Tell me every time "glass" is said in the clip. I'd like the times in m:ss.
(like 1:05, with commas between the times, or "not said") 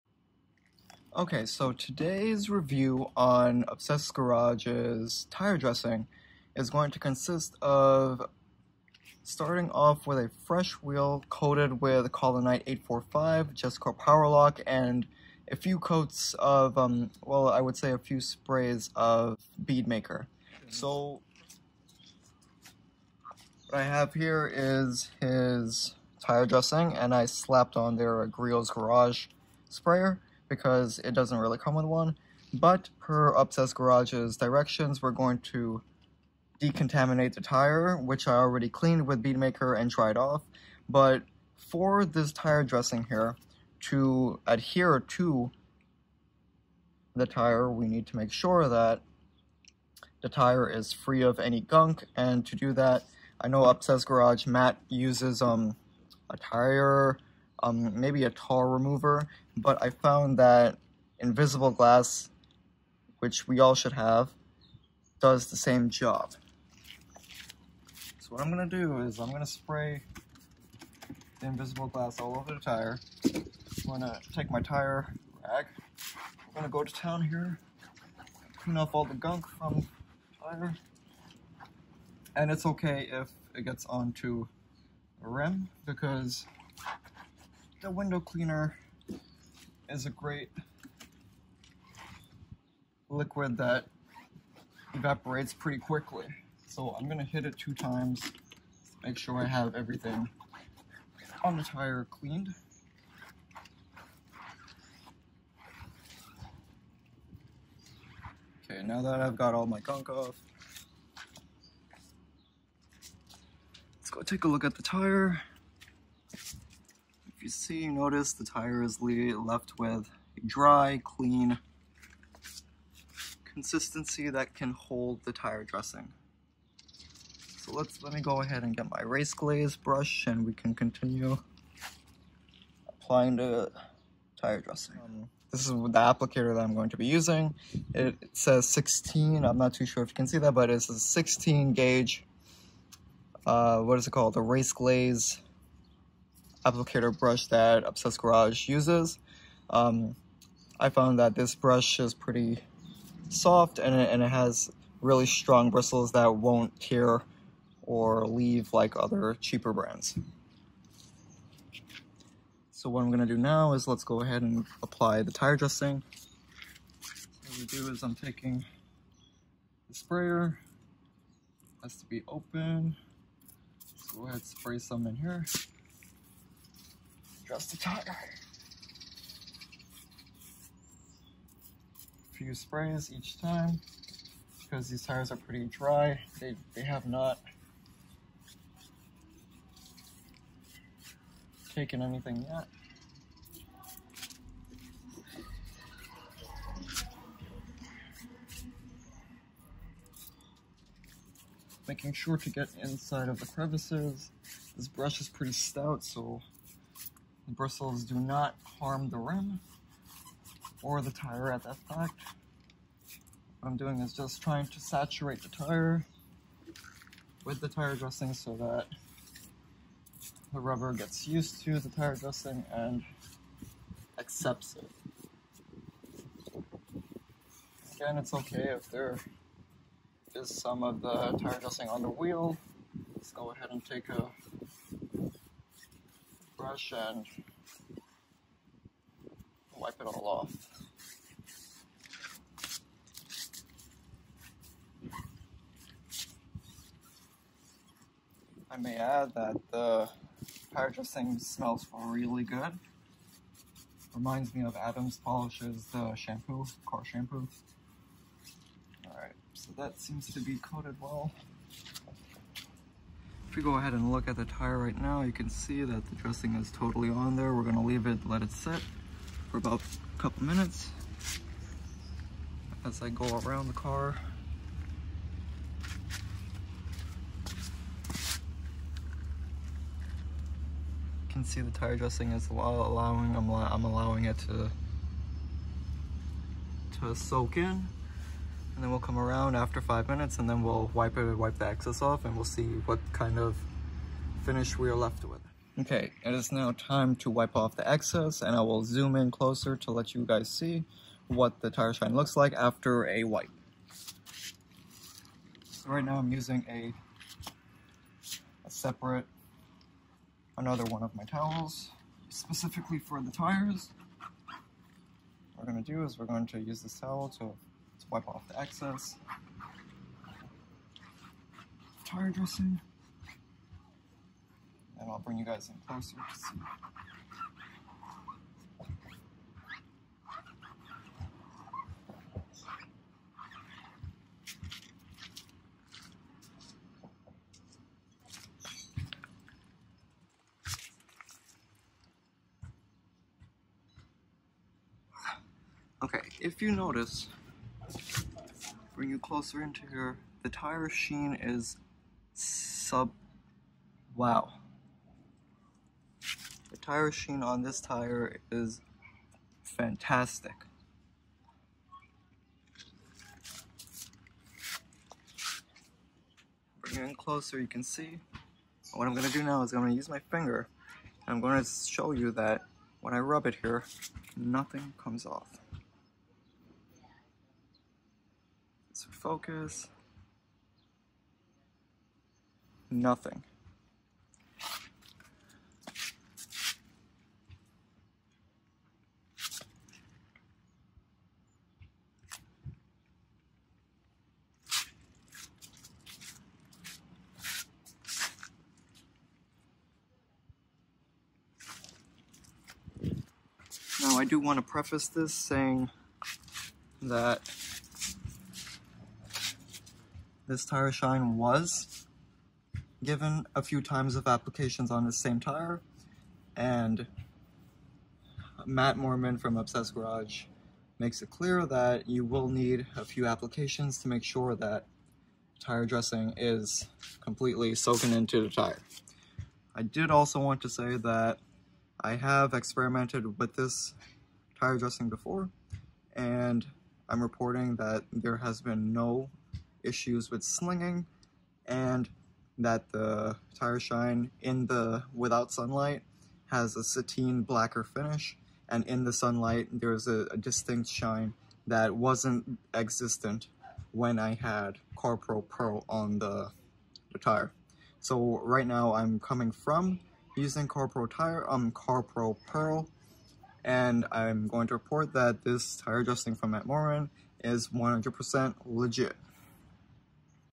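1:01, 1:11.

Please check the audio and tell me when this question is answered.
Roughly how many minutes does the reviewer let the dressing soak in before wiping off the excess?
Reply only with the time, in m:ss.
4:49.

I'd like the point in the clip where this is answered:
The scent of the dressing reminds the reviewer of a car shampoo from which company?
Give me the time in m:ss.
4:14.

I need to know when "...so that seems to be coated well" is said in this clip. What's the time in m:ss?
4:19.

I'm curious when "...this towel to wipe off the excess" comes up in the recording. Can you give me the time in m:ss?
5:16.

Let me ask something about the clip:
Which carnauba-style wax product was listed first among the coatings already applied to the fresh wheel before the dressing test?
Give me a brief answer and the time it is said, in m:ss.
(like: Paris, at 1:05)
Collinite 845, at 0:12.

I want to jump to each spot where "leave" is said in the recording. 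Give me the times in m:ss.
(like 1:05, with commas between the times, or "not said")
2:38, 4:27.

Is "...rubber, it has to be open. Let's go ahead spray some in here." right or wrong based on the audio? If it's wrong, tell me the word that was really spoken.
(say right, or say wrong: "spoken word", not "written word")
wrong: "sprayer", not "rubber".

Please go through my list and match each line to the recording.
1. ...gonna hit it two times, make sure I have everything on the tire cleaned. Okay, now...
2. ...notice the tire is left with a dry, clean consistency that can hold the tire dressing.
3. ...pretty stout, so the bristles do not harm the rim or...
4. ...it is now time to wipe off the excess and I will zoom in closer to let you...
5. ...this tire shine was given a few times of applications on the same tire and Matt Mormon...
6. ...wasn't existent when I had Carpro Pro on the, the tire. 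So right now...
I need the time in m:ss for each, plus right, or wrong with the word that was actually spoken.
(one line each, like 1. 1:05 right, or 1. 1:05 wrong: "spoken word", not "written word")
1. 1:37 right
2. 1:57 right
3. 3:25 right
4. 4:56 right
5. 6:50 right
6. 7:31 right.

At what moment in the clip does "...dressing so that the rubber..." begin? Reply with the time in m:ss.
3:37.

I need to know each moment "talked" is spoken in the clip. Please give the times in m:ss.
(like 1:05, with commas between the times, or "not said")
not said.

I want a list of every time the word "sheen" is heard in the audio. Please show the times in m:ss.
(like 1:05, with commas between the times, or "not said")
5:50, 5:57.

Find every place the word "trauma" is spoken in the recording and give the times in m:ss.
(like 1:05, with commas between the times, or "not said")
not said.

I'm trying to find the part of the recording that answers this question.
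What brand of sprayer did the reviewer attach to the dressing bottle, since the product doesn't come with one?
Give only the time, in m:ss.
0:28.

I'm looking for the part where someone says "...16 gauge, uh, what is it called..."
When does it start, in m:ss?
2:20.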